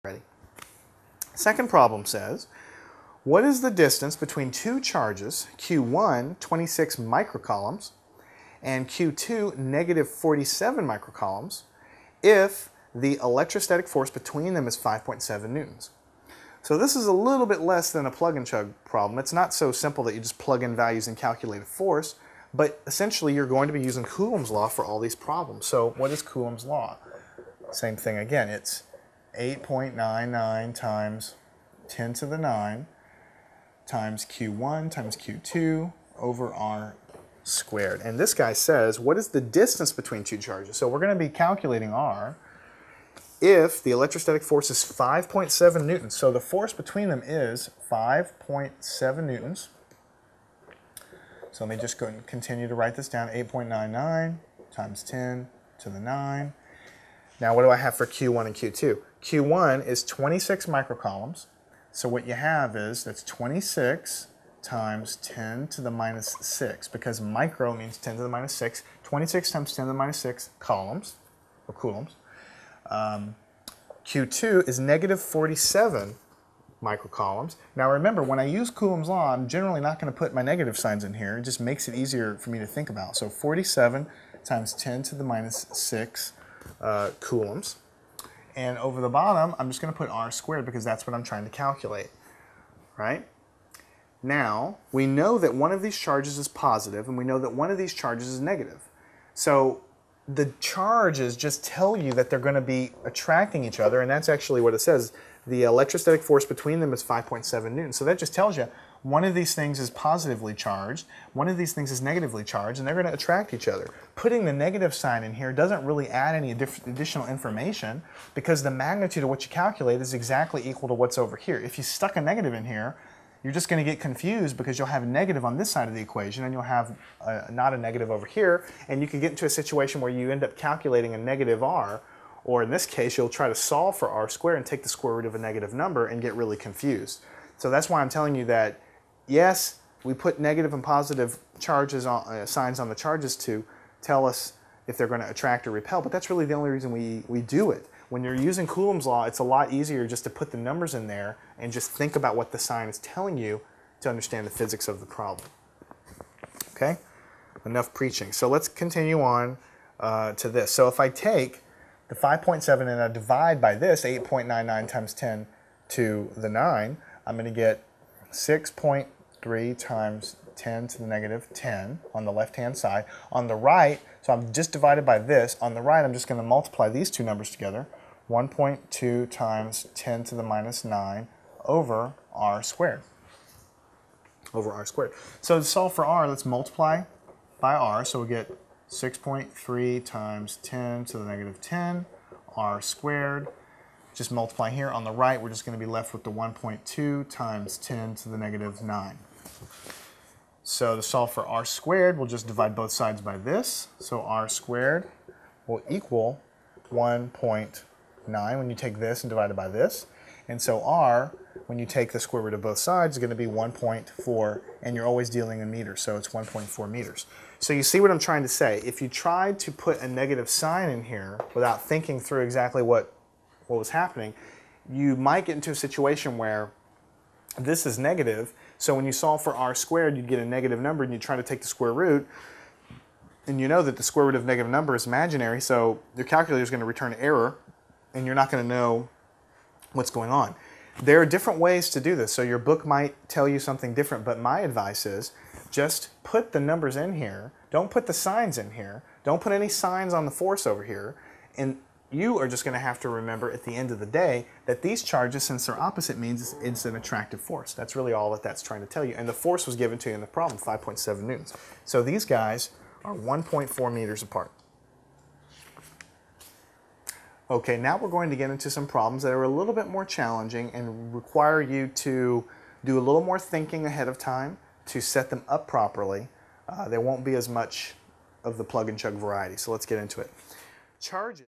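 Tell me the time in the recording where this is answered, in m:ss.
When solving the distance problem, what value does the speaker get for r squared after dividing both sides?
3:26.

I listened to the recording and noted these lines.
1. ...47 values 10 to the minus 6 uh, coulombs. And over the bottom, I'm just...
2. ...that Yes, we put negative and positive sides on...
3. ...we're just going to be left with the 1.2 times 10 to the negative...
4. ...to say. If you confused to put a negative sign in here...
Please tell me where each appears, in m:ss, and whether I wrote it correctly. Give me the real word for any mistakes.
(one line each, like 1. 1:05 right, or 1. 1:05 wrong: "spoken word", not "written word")
1. 1:23 wrong: "times", not "values"
2. 2:18 wrong: "charges", not "sides"
3. 3:15 right
4. 3:38 wrong: "tried", not "confused".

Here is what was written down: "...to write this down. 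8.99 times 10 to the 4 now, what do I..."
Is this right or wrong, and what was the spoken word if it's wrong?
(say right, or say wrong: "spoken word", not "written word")
wrong: "9", not "4".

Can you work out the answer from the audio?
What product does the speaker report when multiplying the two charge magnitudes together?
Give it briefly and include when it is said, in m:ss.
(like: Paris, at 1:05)
1.2 times 10 to the minus 9, at 2:58.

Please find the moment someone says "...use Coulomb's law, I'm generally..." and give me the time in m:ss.
1:18.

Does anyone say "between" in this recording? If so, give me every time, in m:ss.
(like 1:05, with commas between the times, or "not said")
0:04, 0:14, 0:39, 0:46, 1:46.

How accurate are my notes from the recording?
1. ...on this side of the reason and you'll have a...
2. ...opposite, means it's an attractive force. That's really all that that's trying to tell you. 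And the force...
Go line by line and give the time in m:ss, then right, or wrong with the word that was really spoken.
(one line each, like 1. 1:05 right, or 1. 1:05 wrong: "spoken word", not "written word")
1. 2:05 wrong: "equation", not "reason"
2. 4:15 right.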